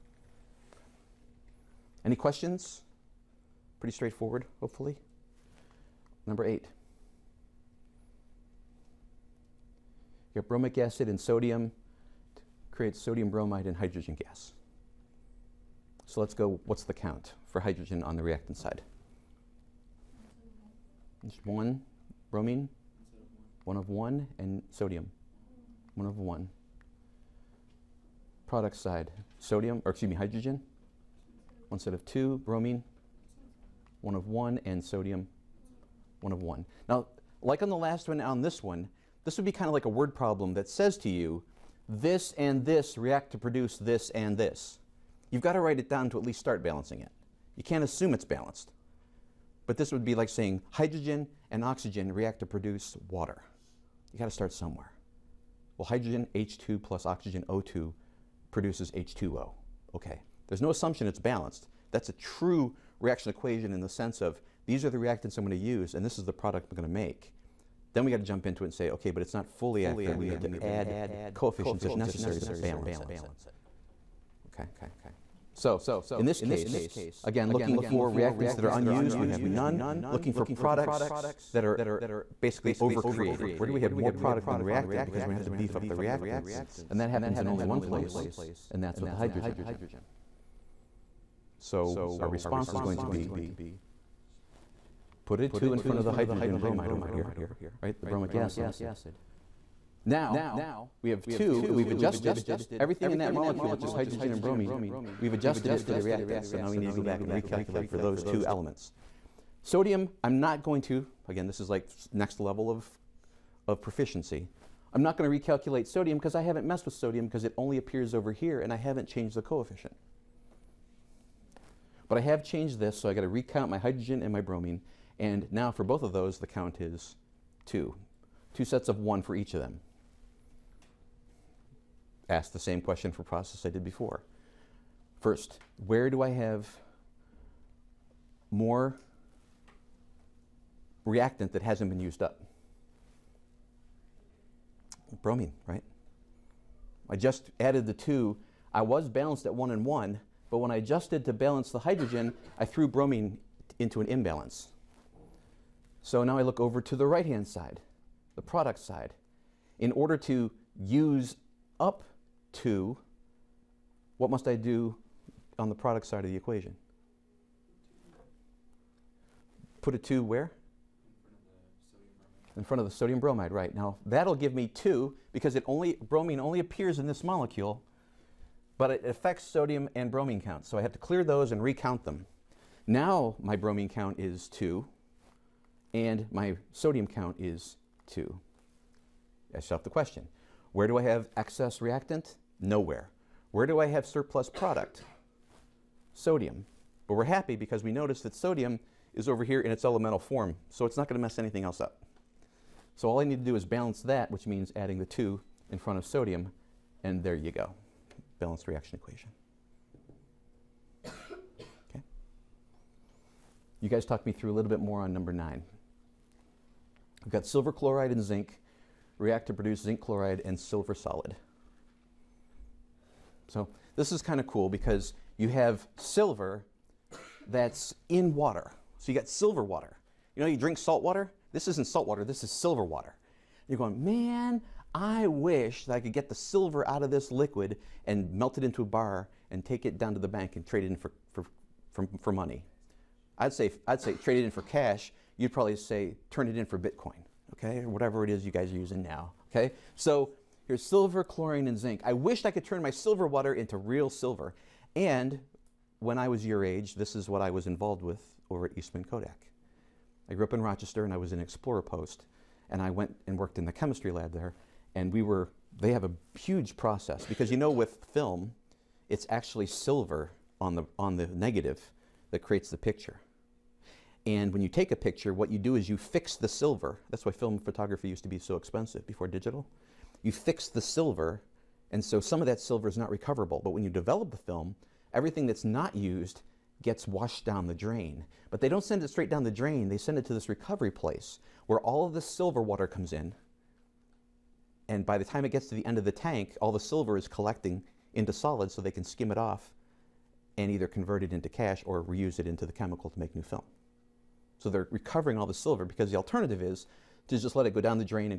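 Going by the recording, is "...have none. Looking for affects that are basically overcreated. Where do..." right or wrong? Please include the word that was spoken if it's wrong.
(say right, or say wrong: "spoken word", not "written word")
wrong: "products", not "affects".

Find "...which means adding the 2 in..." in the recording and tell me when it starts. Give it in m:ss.
3:24.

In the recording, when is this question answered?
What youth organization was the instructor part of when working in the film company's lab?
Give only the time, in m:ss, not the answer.
4:21.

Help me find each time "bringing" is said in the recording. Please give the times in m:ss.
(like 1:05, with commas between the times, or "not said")
not said.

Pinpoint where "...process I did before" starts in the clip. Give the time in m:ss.
2:13.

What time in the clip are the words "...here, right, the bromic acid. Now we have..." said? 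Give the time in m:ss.
1:37.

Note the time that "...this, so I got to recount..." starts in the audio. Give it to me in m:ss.
2:02.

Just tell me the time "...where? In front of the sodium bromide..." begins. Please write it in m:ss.
2:50.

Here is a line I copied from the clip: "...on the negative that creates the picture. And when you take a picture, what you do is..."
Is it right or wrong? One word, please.
right.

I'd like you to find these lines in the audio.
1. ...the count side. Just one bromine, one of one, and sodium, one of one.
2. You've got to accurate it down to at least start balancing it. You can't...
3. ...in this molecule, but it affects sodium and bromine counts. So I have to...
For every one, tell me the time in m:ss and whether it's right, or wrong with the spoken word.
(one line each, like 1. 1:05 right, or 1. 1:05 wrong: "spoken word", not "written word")
1. 0:18 wrong: "reactant", not "count"
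2. 0:45 wrong: "write", not "accurate"
3. 2:56 right.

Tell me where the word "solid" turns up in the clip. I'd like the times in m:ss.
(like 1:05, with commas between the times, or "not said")
3:40, 4:58.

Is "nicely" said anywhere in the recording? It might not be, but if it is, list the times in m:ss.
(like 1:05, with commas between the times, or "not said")
not said.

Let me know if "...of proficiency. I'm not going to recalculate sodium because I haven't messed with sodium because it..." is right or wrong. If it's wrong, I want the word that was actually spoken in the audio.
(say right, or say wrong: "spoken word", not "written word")
right.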